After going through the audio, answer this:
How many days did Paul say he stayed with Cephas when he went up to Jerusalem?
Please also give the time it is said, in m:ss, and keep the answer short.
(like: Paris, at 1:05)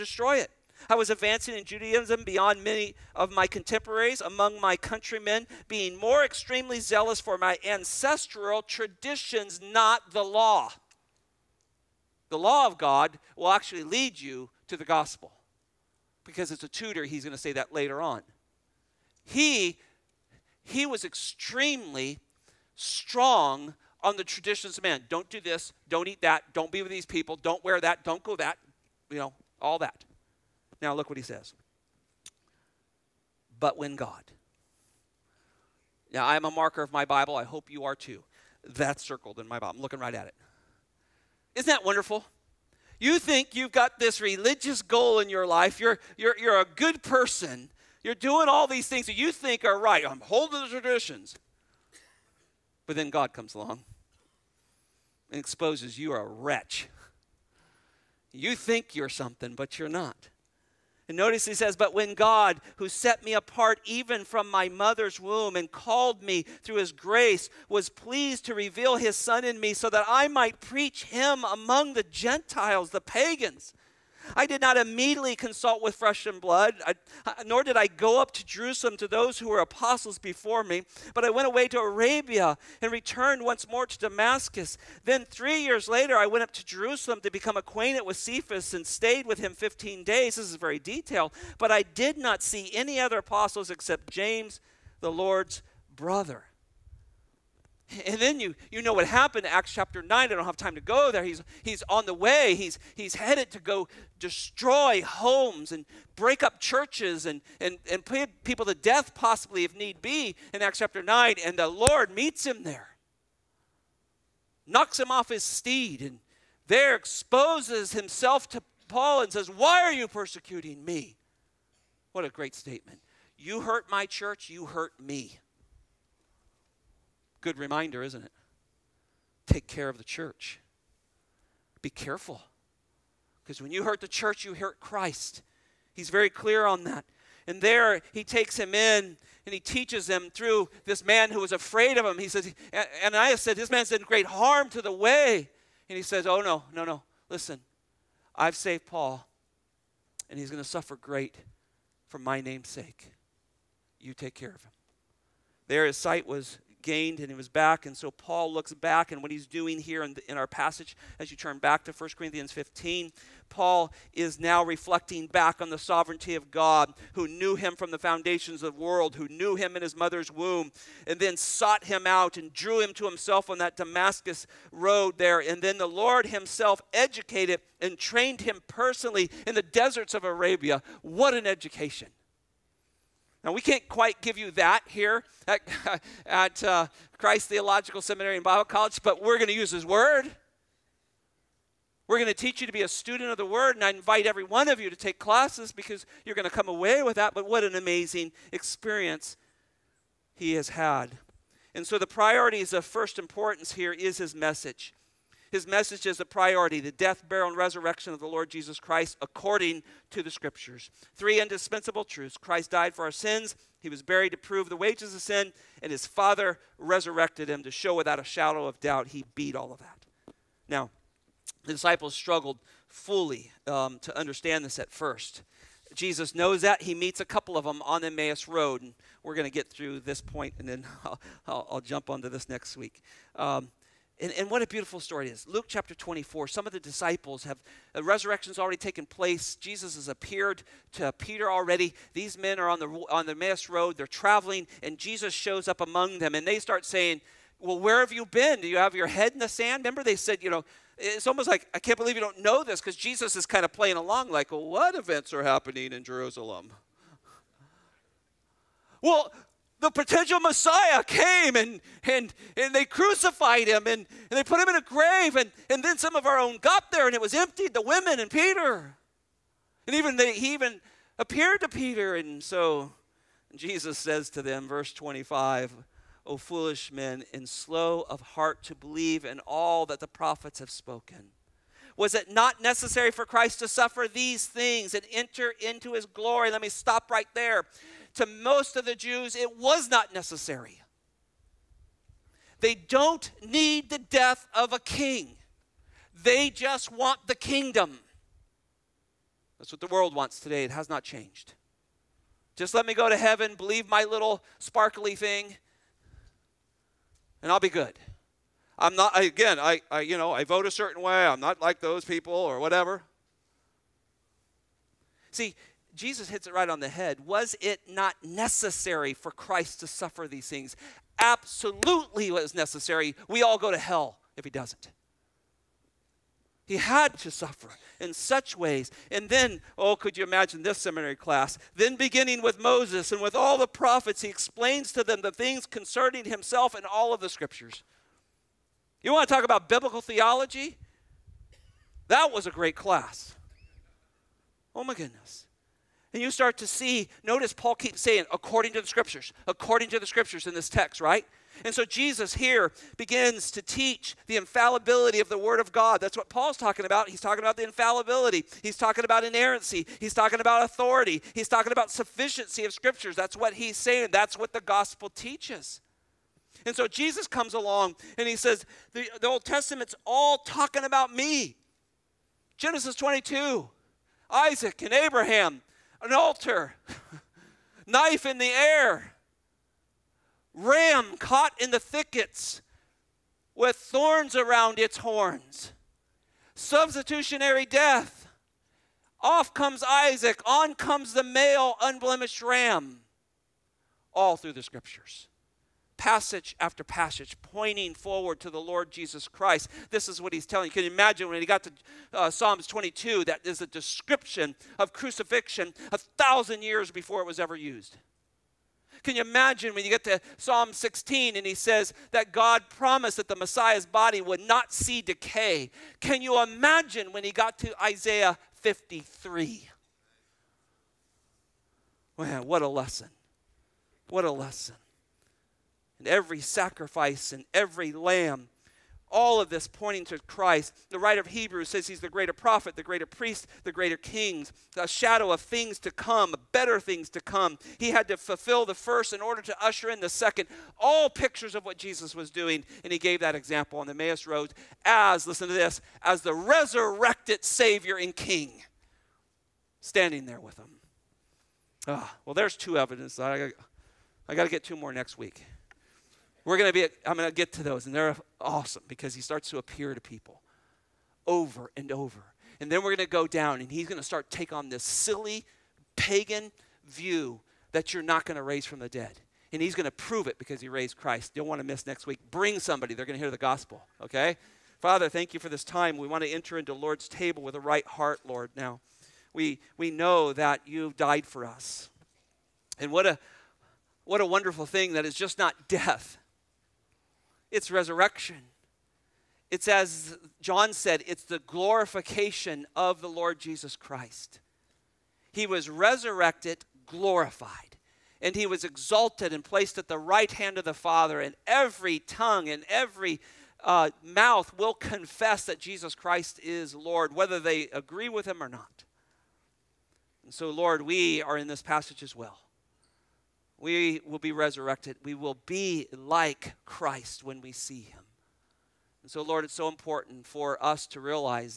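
15, at 1:29.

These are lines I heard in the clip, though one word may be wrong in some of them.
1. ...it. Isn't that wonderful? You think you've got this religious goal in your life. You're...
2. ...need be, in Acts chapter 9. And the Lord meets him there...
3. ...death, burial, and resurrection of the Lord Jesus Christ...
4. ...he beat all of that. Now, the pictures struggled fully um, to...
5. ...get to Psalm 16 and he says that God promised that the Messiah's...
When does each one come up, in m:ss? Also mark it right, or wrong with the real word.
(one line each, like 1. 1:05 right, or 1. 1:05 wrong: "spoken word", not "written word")
1. 0:40 right
2. 1:49 right
3. 3:26 right
4. 3:39 wrong: "disciples", not "pictures"
5. 6:49 right.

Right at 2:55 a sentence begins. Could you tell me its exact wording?
And then the Lord himself educated and trained him personally in the deserts of Arabia.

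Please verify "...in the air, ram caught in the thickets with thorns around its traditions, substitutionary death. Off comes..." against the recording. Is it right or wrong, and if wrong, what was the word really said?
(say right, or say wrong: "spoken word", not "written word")
wrong: "horns", not "traditions".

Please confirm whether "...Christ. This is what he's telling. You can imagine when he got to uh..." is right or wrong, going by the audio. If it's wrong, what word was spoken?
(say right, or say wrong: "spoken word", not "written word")
right.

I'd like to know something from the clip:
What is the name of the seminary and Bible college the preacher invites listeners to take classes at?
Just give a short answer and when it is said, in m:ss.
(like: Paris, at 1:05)
Christ Theological Seminary and Bible College, at 3:07.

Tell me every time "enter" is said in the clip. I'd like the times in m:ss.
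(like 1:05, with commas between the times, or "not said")
4:45, 7:56.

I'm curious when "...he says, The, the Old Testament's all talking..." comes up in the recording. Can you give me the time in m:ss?
6:08.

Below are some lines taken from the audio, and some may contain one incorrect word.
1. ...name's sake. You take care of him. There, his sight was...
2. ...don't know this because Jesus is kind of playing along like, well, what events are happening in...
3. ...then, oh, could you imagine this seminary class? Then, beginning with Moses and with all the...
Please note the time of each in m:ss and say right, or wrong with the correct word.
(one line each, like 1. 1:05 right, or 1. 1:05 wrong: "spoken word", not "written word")
1. 2:32 right
2. 4:12 right
3. 5:29 right.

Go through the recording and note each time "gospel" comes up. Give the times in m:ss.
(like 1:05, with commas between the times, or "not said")
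0:14, 6:04, 7:53.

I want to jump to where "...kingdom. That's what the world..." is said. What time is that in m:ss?
4:57.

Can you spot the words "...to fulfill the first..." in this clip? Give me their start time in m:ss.
7:18.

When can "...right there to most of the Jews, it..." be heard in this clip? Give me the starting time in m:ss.
4:47.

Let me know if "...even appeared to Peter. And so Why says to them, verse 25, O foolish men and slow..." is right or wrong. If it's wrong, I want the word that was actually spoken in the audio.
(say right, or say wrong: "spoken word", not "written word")
wrong: "Jesus", not "Why".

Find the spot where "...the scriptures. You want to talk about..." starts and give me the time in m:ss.
5:37.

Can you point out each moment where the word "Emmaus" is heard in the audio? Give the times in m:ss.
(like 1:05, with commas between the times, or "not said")
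3:48, 4:03, 7:23.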